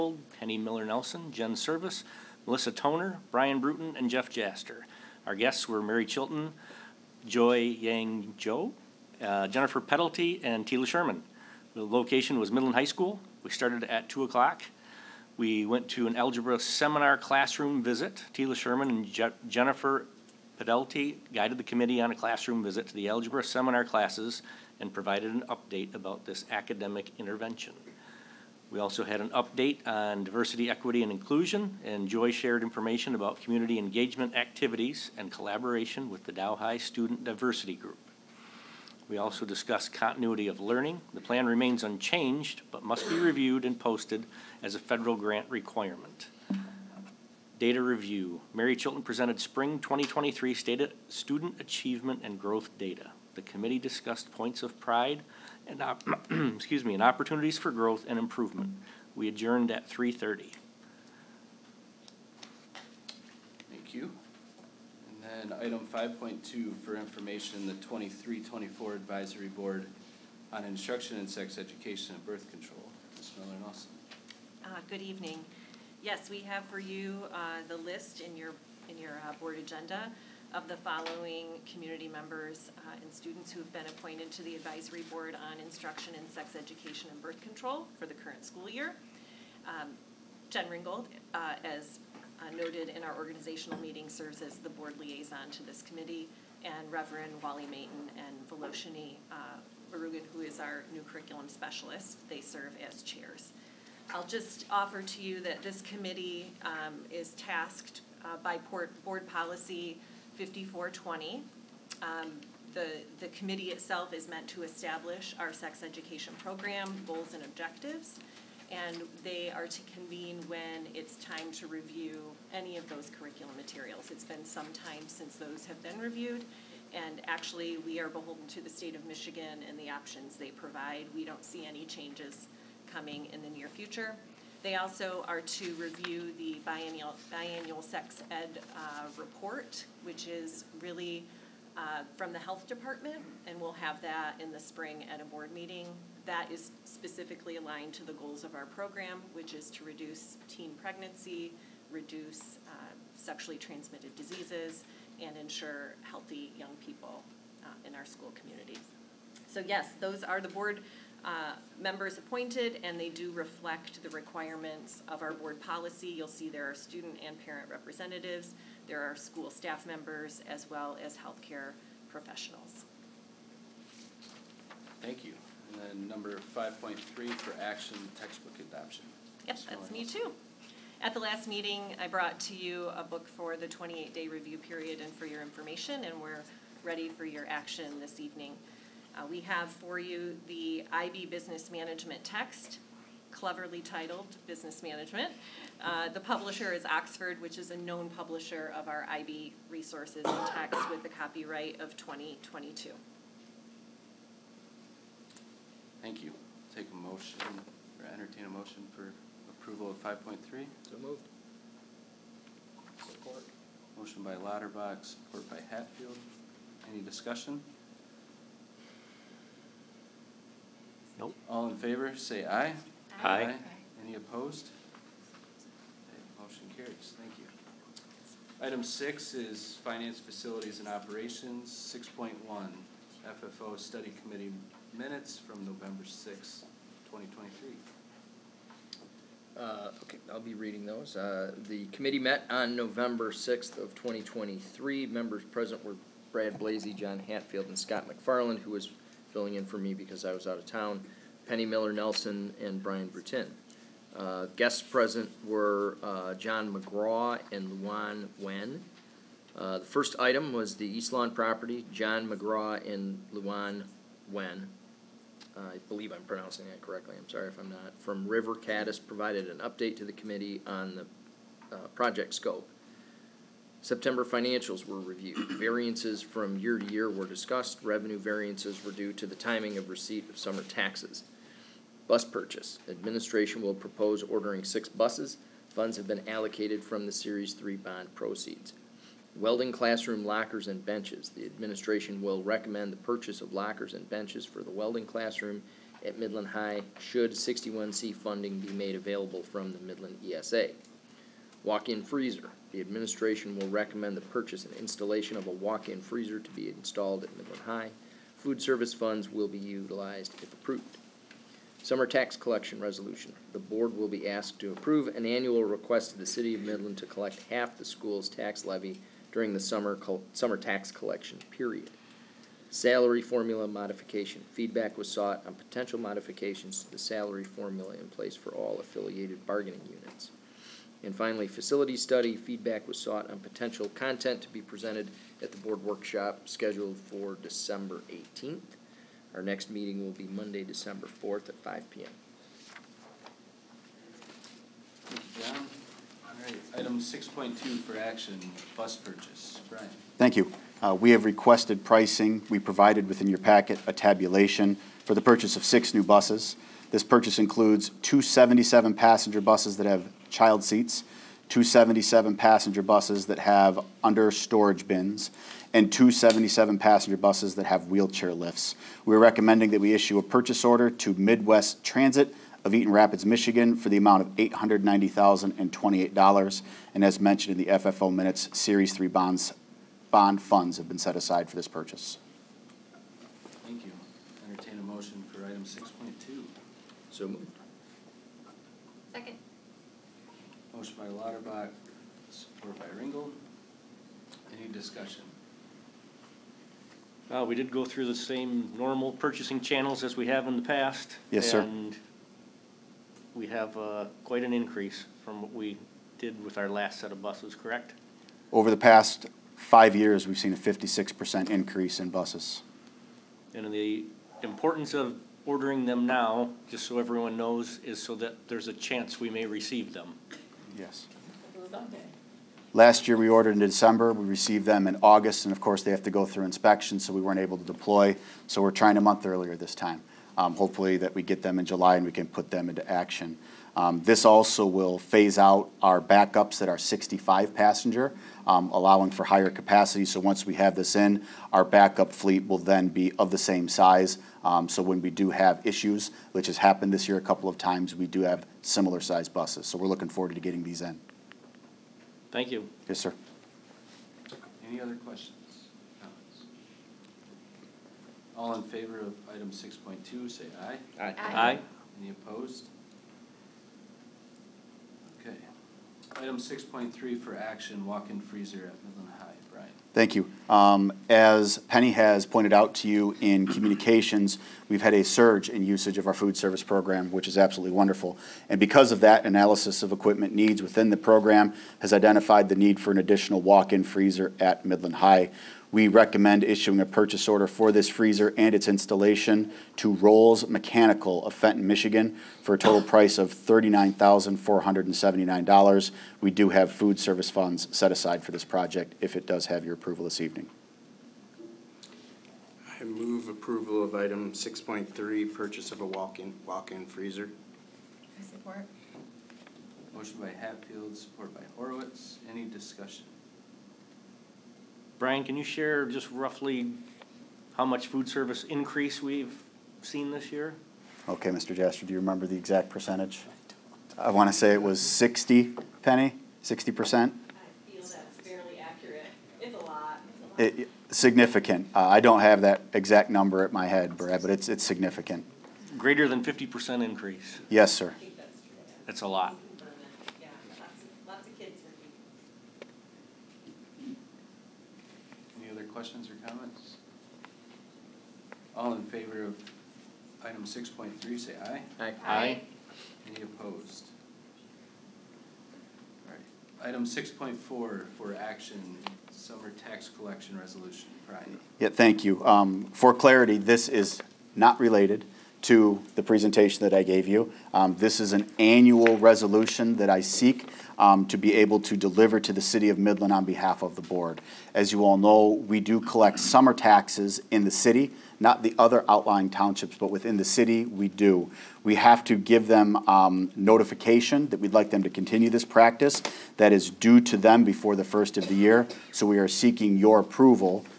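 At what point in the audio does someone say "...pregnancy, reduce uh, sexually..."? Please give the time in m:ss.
2:30.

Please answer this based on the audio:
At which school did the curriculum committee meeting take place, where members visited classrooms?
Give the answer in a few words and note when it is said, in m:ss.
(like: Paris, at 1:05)
Midland High School, at 0:12.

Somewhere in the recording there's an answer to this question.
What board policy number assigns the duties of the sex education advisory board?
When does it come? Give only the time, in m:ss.
1:50.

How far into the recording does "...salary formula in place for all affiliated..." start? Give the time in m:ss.
5:26.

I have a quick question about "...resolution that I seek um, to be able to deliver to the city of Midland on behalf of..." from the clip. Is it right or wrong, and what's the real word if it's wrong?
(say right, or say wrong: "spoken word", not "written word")
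right.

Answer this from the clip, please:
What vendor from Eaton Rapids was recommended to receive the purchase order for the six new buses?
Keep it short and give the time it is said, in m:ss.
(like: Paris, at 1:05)
Midwest Transit, at 6:11.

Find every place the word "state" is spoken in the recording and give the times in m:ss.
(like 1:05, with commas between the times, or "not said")
0:50, 2:08.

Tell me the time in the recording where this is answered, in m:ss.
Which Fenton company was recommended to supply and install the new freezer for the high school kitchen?
8:09.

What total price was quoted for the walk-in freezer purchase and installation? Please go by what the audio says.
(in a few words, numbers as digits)
$39,479.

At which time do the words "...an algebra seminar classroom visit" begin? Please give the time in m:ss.
0:16.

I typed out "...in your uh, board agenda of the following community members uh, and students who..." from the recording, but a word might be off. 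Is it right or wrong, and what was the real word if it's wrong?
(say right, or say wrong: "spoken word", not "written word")
right.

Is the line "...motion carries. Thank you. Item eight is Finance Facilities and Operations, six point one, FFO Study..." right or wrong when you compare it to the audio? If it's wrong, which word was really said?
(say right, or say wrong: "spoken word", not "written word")
wrong: "six", not "eight".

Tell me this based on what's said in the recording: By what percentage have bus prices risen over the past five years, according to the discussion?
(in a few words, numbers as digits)
56%.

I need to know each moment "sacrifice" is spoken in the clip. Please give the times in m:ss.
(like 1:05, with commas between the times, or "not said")
not said.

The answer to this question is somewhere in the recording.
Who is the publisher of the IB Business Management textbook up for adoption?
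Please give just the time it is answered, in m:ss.
3:16.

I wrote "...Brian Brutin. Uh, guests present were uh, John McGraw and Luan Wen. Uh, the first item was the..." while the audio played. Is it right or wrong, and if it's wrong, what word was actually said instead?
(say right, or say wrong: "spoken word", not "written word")
right.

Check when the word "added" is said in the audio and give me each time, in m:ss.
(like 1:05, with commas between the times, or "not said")
not said.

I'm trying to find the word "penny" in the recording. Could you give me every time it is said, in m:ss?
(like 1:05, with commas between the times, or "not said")
0:00, 4:11, 7:51, 8:45.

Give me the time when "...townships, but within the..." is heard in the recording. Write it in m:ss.
9:39.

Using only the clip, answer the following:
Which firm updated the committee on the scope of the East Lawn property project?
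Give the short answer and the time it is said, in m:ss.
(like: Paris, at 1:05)
River Caddis, at 4:28.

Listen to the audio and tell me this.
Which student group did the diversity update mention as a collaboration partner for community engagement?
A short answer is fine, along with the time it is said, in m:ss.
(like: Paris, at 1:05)
Dow High Student Diversity Group, at 0:36.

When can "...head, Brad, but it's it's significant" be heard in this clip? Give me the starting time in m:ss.
8:53.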